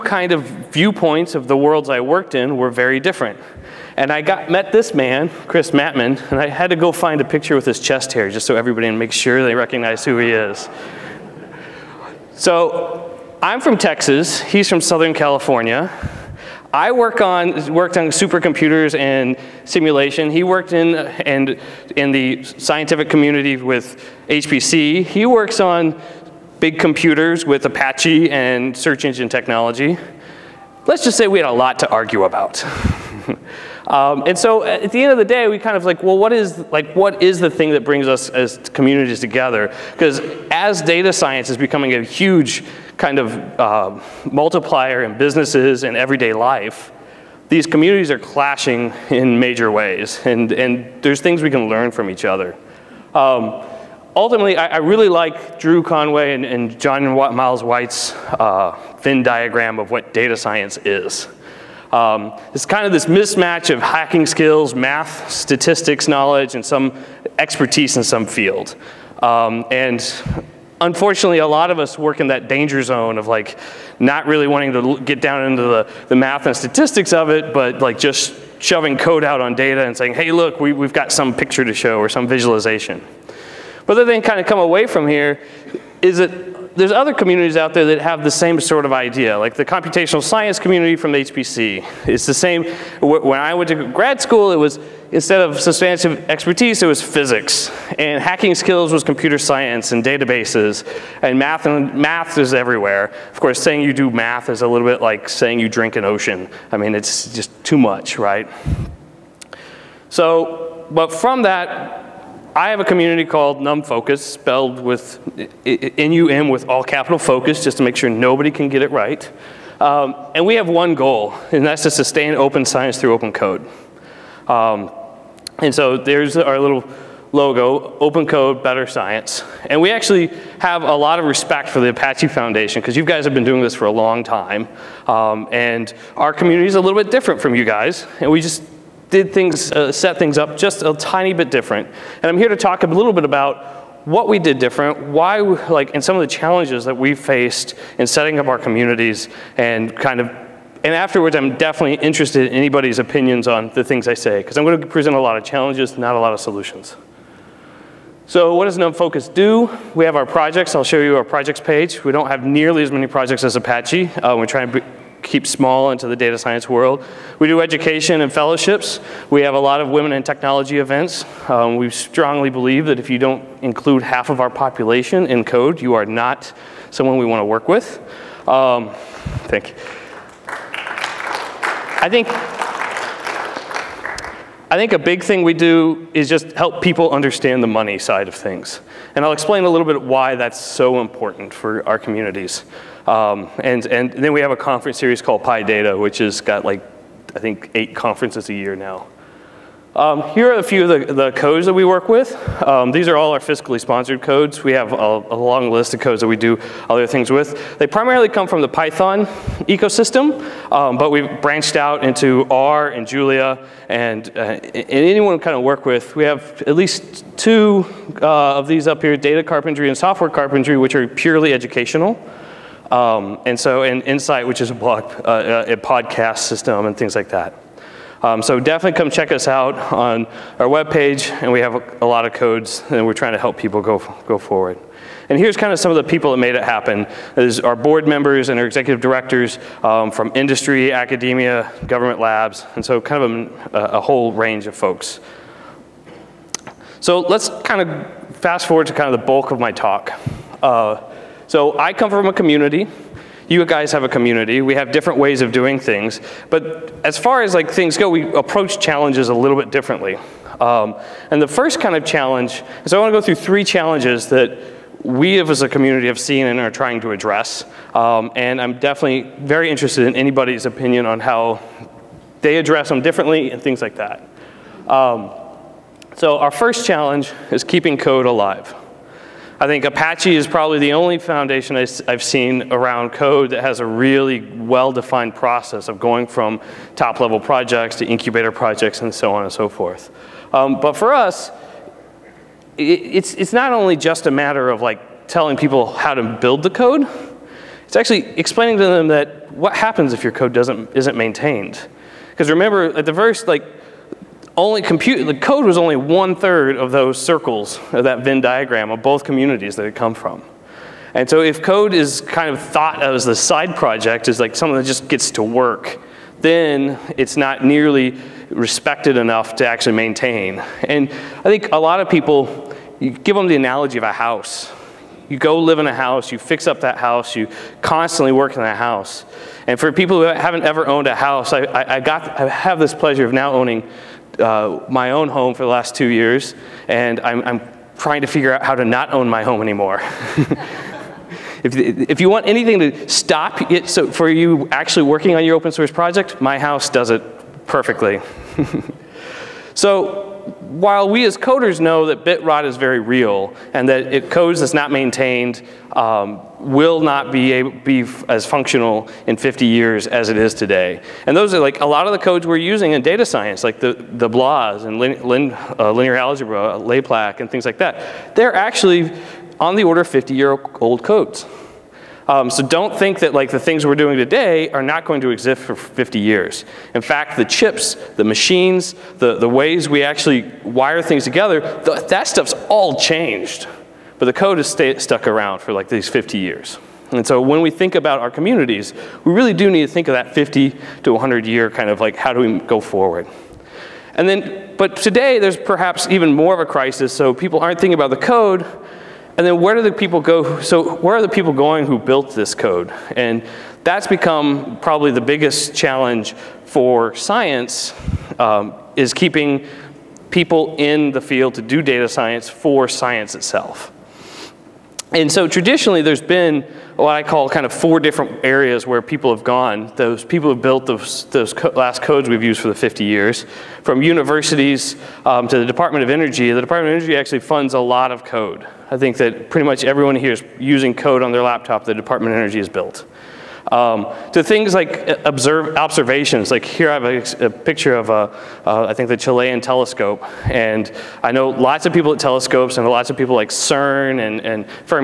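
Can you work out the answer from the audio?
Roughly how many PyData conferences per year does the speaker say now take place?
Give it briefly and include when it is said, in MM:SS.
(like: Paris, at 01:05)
8, at 03:17.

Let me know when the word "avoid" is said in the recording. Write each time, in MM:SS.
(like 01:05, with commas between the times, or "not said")
not said.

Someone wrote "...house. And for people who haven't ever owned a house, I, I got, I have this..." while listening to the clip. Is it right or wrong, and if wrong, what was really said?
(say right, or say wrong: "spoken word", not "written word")
right.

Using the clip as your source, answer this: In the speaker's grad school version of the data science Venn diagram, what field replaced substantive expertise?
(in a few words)
physics.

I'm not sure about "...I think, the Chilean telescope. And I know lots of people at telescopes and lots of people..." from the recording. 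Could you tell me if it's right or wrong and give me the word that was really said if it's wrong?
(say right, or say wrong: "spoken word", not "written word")
right.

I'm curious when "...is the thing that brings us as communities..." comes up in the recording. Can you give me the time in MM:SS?
00:37.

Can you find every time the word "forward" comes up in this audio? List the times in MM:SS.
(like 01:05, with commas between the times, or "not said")
03:54, 04:08, 06:32.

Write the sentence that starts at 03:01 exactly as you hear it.
I think I think a big thing we do is just help people understand the money side of things.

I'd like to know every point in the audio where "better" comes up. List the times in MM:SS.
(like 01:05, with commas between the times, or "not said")
02:08.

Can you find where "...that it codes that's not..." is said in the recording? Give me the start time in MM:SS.
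05:53.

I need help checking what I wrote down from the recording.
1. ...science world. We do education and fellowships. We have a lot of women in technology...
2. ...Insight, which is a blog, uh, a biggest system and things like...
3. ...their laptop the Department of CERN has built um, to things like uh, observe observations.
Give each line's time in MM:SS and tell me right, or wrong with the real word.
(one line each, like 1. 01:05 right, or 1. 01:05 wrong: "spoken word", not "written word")
1. 02:46 right
2. 03:44 wrong: "podcast", not "biggest"
3. 07:11 wrong: "Energy", not "CERN".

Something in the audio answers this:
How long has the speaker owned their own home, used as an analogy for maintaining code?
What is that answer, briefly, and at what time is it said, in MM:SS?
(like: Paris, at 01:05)
2 years, at 05:35.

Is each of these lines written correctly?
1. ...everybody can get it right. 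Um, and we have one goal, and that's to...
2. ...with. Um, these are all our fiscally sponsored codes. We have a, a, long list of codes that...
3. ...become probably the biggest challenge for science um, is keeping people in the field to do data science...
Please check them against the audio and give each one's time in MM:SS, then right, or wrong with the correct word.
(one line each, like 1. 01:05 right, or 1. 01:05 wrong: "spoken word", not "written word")
1. 01:58 wrong: "nobody", not "everybody"
2. 03:22 right
3. 06:44 right.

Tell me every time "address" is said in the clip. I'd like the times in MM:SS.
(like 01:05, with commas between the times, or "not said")
04:27, 04:32.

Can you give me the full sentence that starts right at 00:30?
Let's just say we had a lot to argue about.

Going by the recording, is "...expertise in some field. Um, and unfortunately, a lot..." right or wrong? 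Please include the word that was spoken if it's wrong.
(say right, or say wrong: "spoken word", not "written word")
right.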